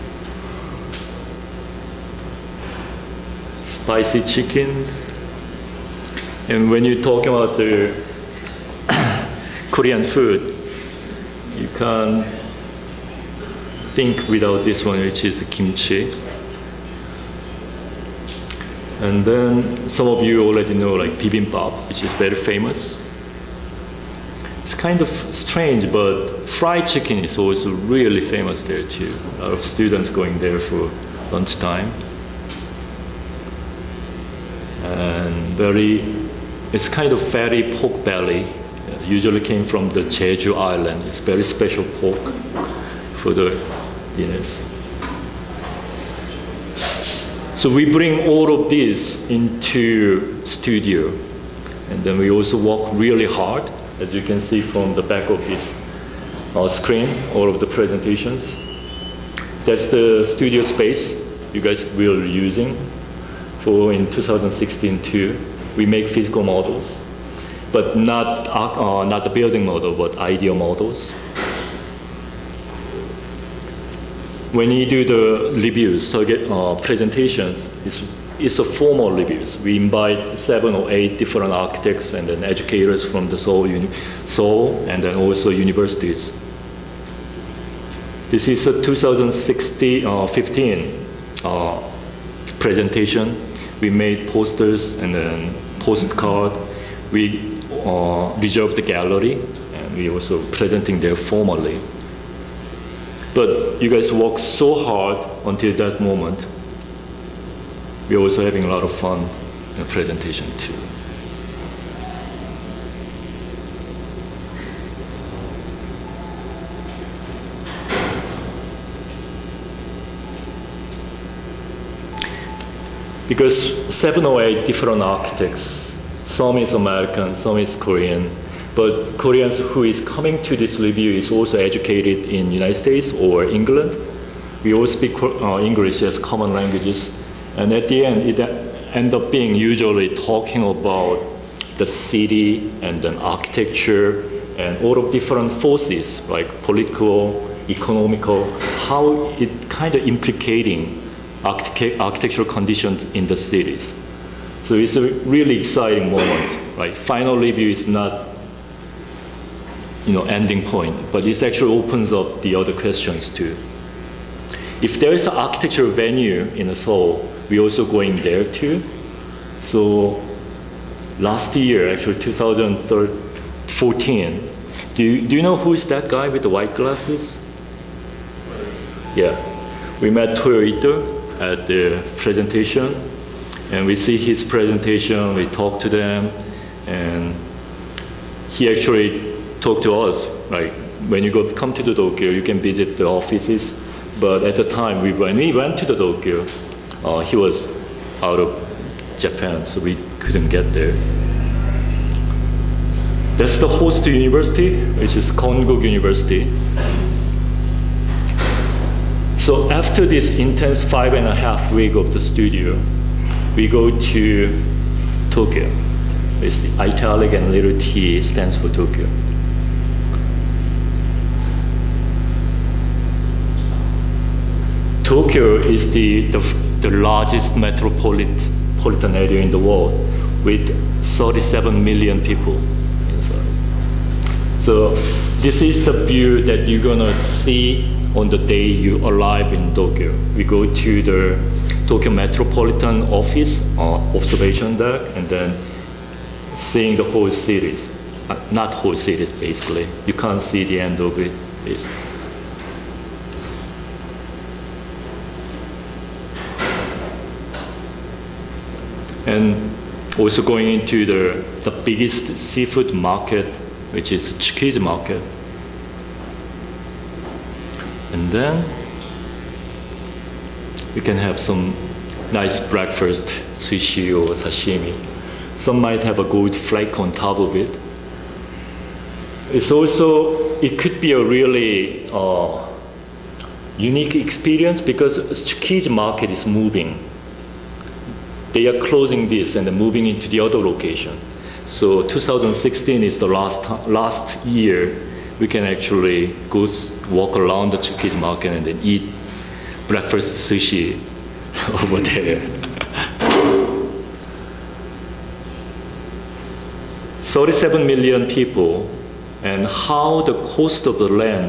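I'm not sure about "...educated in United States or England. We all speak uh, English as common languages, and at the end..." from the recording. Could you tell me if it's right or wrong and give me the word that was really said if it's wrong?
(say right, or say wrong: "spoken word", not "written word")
right.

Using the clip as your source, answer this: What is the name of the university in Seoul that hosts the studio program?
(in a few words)
Konkuk University.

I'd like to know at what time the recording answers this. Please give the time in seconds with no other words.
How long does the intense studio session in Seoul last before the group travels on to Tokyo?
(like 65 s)
210 s.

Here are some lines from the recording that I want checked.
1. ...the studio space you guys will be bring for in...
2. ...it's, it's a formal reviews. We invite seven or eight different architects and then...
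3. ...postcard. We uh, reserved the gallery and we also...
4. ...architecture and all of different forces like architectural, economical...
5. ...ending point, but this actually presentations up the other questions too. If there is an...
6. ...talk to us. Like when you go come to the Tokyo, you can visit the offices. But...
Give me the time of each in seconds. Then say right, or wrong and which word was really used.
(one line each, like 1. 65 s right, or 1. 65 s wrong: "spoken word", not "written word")
1. 59 s wrong: "using", not "bring"
2. 77 s right
3. 95 s right
4. 143 s wrong: "political", not "architectural"
5. 160 s wrong: "opens", not "presentations"
6. 189 s right.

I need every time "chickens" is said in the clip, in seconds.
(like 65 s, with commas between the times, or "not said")
4 s, 26 s.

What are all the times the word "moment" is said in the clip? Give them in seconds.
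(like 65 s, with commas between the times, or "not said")
105 s, 156 s.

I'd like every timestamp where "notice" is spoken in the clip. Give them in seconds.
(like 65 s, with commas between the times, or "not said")
not said.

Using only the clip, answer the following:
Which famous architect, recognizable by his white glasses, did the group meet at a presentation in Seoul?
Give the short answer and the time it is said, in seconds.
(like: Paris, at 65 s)
Toyo Ito, at 180 s.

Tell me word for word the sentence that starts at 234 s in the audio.
So this is the view that you're gonna see on the day you arrive in Tokyo.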